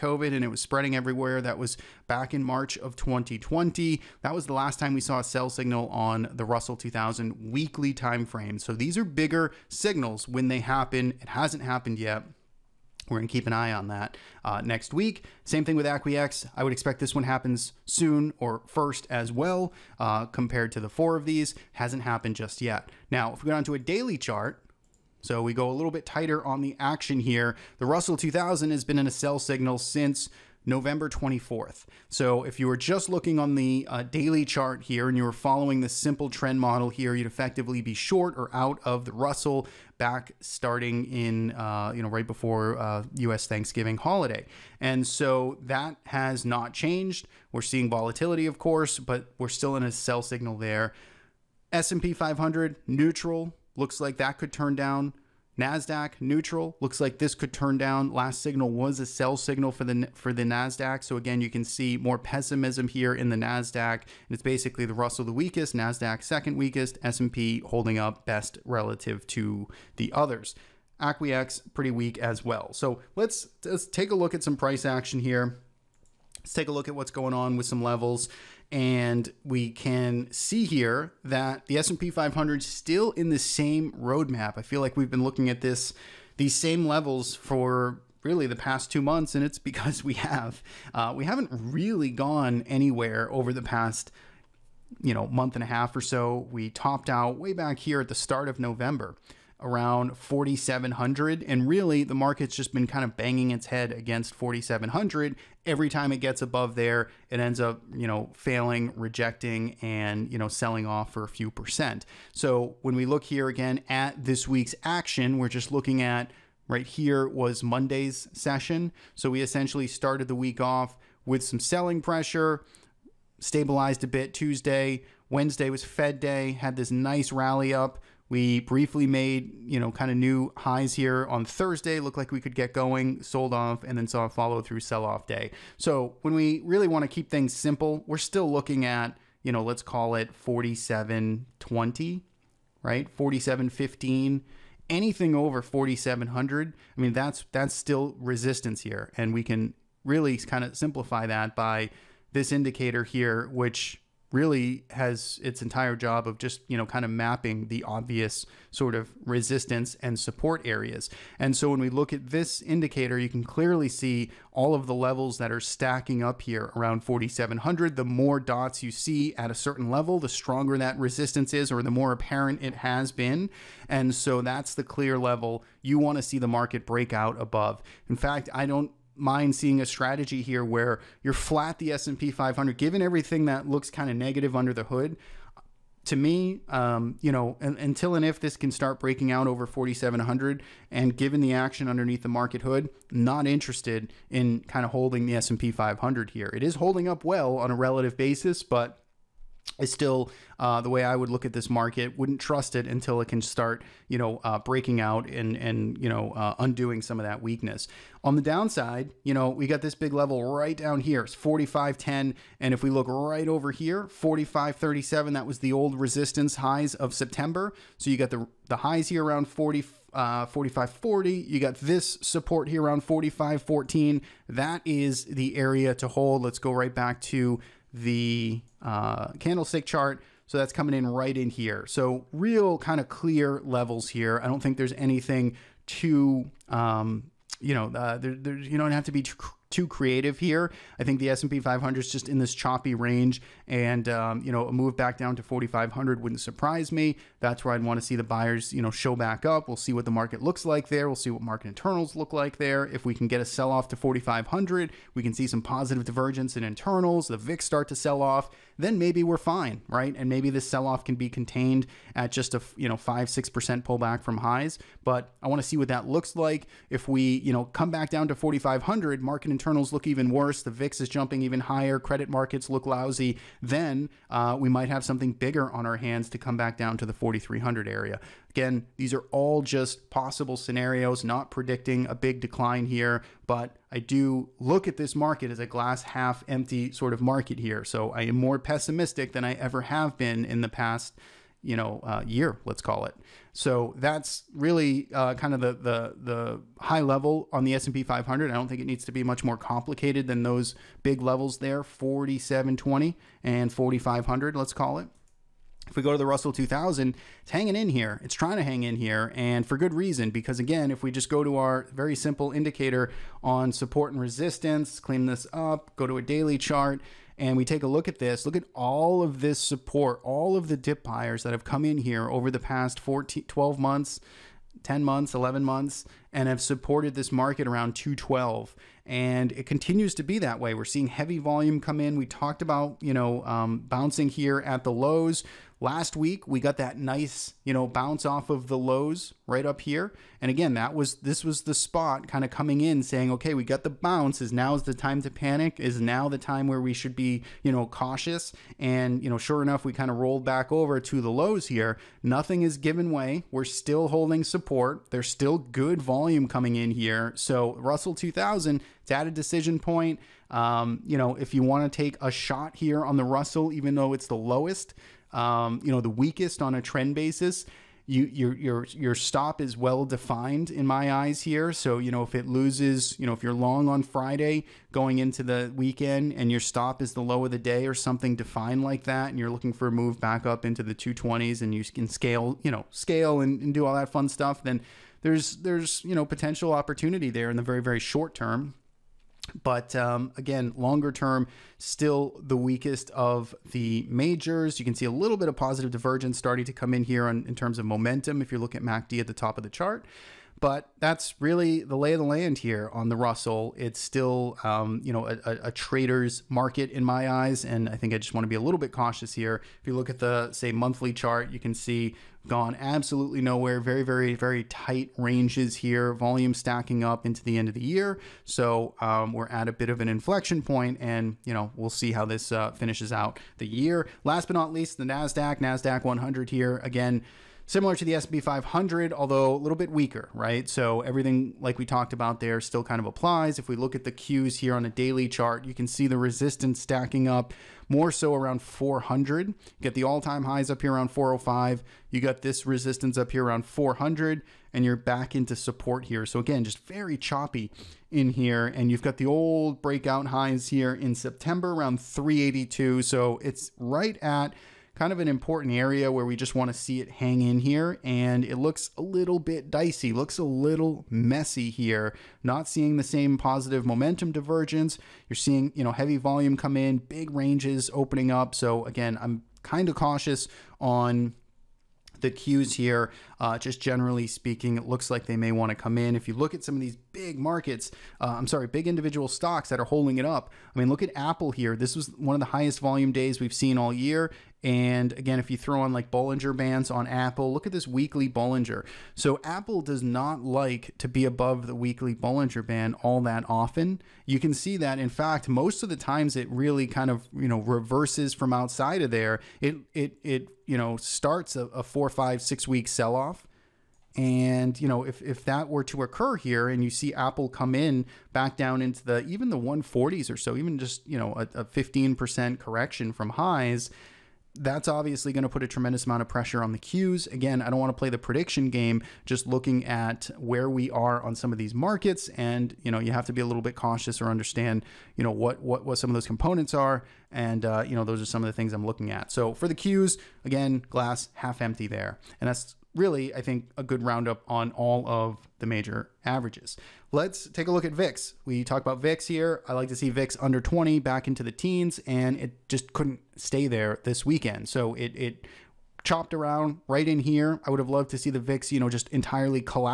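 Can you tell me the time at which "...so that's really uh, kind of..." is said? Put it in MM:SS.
04:53.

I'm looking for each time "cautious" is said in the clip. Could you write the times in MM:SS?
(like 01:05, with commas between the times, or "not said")
05:47, 06:48, 07:49, 08:43.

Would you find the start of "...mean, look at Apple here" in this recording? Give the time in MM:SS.
08:00.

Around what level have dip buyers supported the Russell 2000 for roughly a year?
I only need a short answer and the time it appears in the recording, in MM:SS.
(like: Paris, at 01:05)
212, at 05:27.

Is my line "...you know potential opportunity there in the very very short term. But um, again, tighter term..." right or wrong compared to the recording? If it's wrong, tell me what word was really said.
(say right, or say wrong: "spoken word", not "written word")
wrong: "longer", not "tighter".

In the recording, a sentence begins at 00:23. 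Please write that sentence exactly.
Now, if we go down to a daily chart, so we go a little bit tighter on the action here.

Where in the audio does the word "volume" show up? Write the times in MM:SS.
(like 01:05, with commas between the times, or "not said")
05:31, 05:56, 06:56, 07:46, 08:02.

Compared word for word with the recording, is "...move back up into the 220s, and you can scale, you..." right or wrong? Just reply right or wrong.
right.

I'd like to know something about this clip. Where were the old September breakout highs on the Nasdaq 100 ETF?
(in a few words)
382.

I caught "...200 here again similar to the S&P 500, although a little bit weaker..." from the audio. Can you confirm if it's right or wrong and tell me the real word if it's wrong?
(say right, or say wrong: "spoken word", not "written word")
wrong: "100", not "200".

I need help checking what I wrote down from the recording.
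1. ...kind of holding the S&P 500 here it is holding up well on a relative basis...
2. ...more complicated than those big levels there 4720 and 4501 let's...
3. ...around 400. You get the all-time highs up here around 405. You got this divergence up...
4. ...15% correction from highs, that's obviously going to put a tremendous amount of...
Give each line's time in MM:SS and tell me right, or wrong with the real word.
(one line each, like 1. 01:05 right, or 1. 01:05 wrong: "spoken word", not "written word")
1. 03:14 right
2. 04:59 wrong: "4500", not "4501"
3. 07:18 wrong: "resistance", not "divergence"
4. 08:31 right.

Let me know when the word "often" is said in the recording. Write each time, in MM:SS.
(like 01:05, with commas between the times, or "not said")
08:13.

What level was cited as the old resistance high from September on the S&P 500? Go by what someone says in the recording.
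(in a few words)
4537.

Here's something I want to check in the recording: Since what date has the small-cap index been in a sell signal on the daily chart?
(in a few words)
November 24th.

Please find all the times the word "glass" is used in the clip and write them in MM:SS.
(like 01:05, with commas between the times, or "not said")
04:45, 08:50.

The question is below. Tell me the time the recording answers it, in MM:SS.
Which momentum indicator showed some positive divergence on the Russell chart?
06:38.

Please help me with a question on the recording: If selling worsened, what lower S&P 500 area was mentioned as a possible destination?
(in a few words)
4,300.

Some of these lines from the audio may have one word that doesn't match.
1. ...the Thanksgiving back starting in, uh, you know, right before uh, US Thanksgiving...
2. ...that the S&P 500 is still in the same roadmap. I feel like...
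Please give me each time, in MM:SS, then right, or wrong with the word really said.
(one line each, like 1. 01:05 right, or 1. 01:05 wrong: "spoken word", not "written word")
1. 00:39 wrong: "Russell", not "Thanksgiving"
2. 01:21 right.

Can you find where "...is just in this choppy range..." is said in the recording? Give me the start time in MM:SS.
04:01.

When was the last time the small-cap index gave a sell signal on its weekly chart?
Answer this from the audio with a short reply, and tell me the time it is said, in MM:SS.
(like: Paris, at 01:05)
March 2020, at 00:02.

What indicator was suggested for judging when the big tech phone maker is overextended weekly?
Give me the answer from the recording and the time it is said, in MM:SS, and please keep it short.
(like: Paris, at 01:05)
Bollinger Bands, at 08:06.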